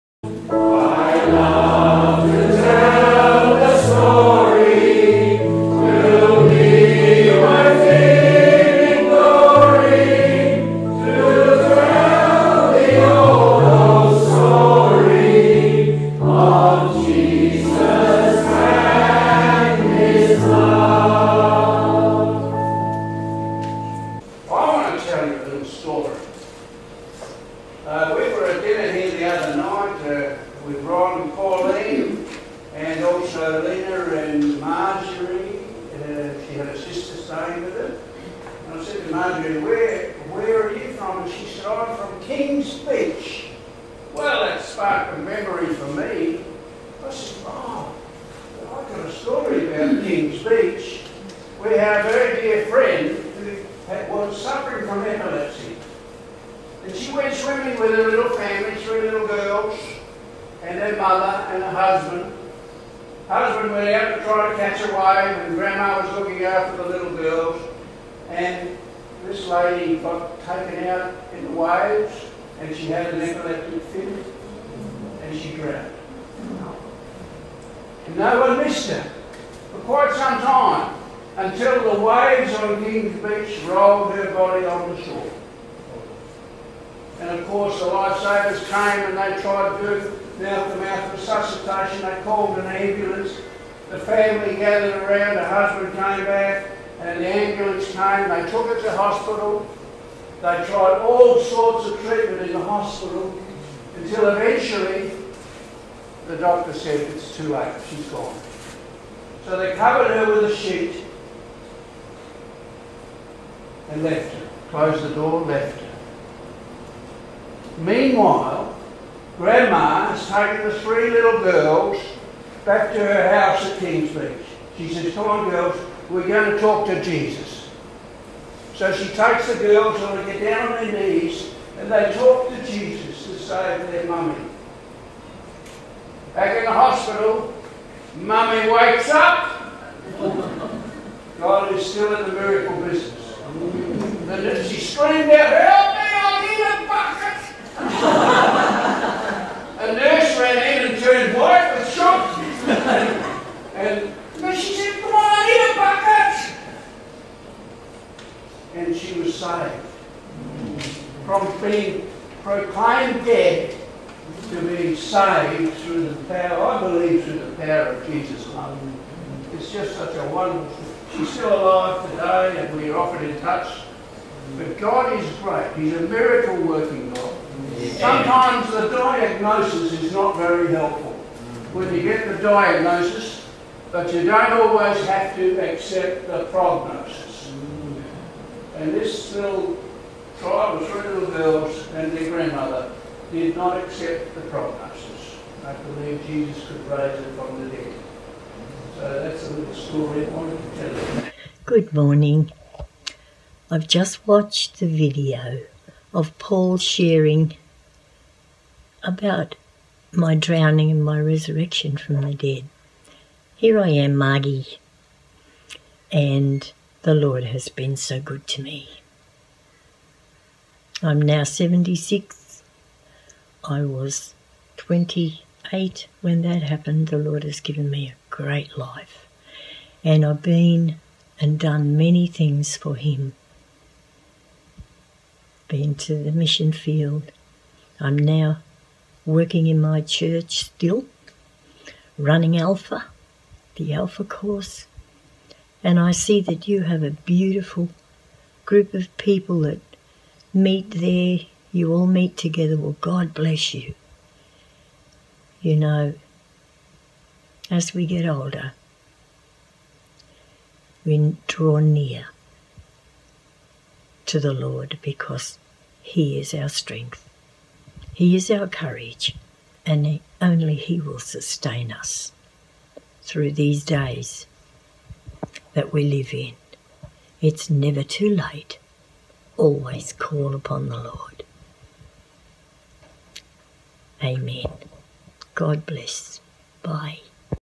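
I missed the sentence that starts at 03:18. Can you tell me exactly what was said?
So that's a little story I wanted to tell you.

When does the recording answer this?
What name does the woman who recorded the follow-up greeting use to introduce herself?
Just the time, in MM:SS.
03:34.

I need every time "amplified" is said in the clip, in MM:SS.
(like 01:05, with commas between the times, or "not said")
not said.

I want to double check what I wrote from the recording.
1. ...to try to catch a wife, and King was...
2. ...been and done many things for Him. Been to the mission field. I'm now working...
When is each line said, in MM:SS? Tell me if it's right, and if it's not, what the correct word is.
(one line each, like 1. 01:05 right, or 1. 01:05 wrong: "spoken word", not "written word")
1. 01:04 wrong: "Grandma", not "King"
2. 03:50 right.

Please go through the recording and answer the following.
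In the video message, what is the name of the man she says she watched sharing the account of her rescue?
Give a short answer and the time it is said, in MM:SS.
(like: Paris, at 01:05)
Paul, at 03:26.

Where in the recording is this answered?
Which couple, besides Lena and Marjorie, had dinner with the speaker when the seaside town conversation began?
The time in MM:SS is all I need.
00:30.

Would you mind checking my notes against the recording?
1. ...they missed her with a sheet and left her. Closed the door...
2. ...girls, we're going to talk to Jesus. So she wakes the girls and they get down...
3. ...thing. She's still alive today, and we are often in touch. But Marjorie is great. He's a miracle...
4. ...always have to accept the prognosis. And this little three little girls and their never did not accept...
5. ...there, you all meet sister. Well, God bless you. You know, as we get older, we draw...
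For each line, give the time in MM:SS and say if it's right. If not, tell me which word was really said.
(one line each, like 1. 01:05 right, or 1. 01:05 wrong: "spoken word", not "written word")
1. 01:49 wrong: "covered", not "missed"
2. 02:05 wrong: "takes", not "wakes"
3. 02:50 wrong: "God", not "Marjorie"
4. 03:04 wrong: "grandmother", not "never"
5. 04:10 wrong: "together", not "sister".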